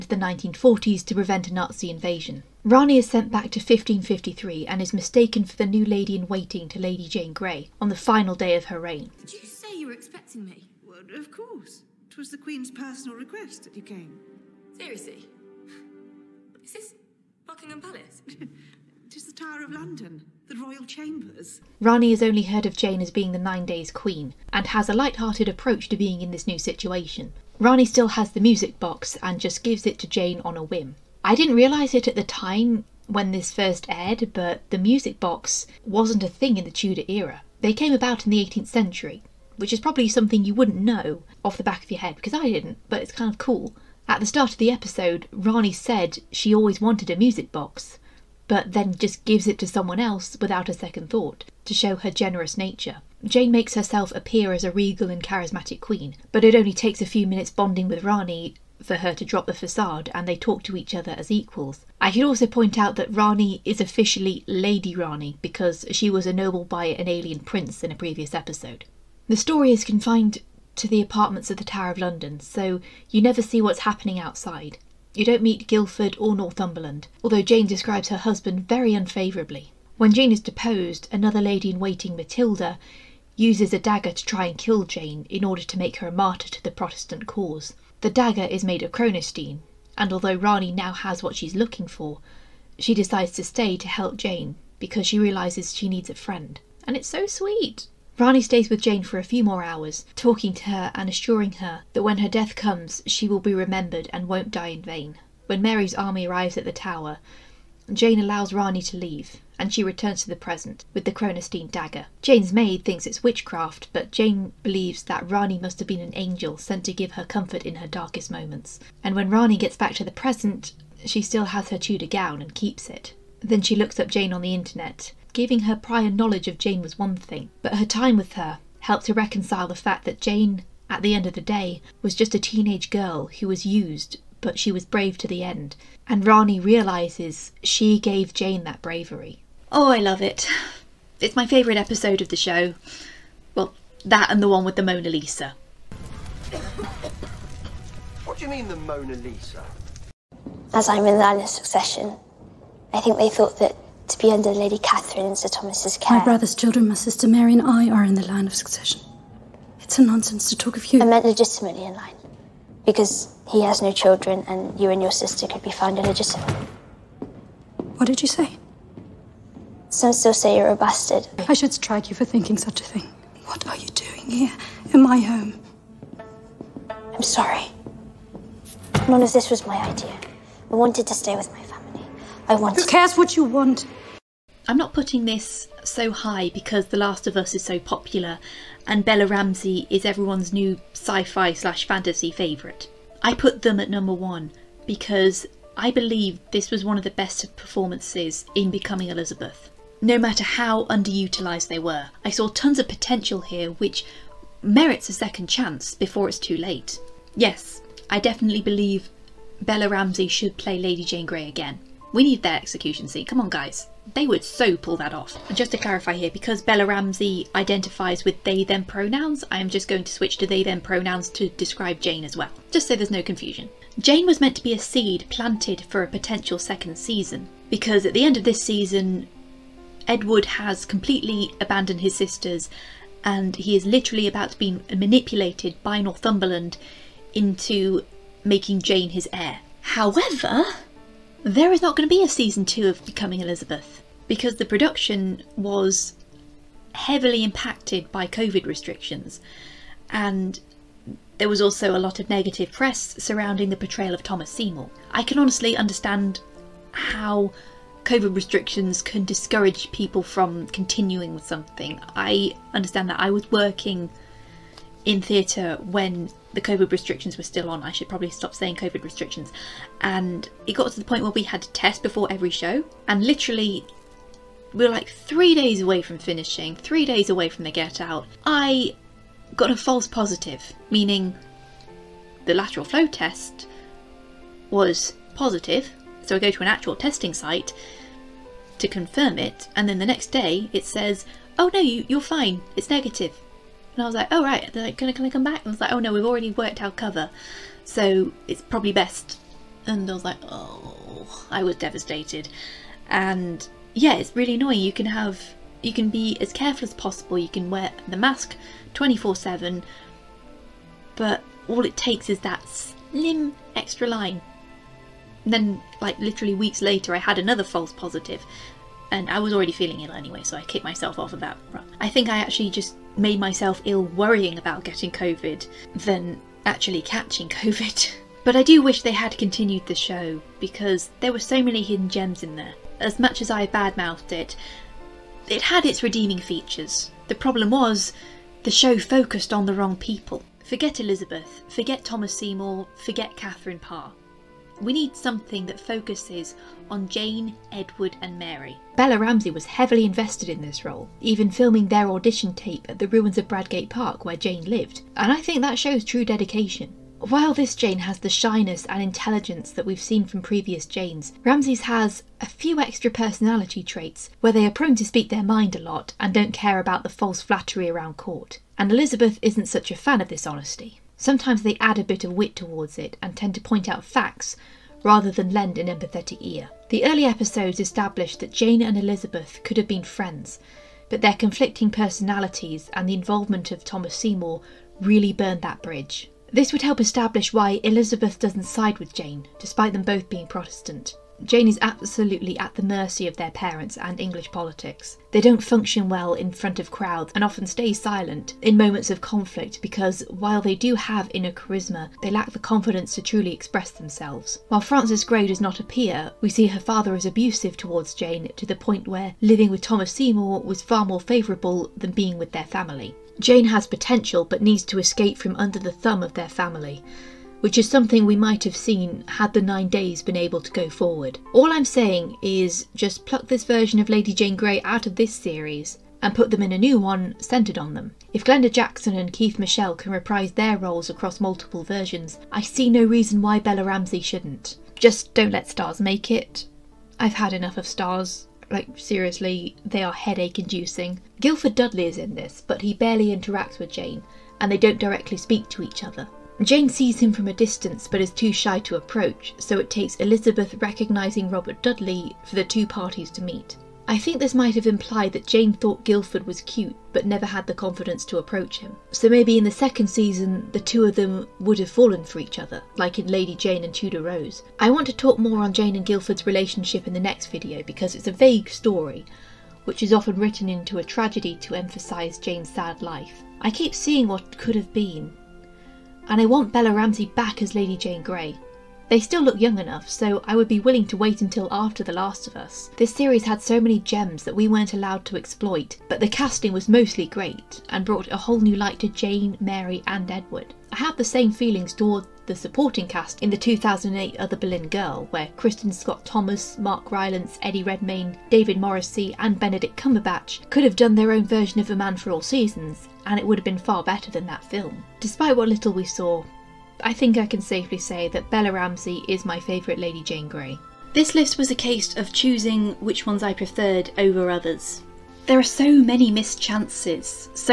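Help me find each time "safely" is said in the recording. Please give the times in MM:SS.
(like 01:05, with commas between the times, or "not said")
08:27.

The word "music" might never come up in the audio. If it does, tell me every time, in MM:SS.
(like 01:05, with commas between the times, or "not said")
00:28, 00:34, 00:47.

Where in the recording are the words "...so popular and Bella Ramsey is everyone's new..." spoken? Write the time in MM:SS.
03:07.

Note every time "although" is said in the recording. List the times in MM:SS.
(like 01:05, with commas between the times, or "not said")
01:17, 01:30.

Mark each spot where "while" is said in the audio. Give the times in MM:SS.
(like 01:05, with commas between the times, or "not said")
05:57, 06:40, 06:44.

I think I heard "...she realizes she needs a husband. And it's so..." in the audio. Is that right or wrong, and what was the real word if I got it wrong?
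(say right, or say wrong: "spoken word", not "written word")
wrong: "friend", not "husband".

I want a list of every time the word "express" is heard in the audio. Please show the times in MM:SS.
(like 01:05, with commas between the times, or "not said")
06:43.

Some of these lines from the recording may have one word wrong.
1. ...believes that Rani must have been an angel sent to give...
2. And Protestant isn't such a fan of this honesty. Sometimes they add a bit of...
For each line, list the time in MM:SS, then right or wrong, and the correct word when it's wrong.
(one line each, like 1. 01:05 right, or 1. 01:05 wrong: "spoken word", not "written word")
1. 01:54 right
2. 06:08 wrong: "Elizabeth", not "Protestant".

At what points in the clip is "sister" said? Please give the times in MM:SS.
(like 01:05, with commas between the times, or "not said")
02:36, 02:45, 03:52.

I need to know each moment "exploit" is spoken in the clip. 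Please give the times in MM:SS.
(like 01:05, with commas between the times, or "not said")
08:05.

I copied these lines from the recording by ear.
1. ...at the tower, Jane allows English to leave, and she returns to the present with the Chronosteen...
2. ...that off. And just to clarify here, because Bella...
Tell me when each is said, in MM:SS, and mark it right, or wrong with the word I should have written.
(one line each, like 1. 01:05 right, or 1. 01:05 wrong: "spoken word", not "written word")
1. 01:46 wrong: "Rani", not "English"
2. 03:34 right.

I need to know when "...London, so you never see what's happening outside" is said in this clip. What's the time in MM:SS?
01:11.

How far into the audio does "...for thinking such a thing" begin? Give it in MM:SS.
02:52.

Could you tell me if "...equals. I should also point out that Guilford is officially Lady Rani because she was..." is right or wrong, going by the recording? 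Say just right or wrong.
wrong.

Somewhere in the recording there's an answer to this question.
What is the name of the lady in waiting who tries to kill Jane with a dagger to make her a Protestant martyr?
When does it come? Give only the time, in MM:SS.
01:22.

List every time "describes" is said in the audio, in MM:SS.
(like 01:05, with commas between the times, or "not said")
01:17, 03:41.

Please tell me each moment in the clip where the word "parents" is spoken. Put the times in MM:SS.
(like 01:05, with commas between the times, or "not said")
06:33.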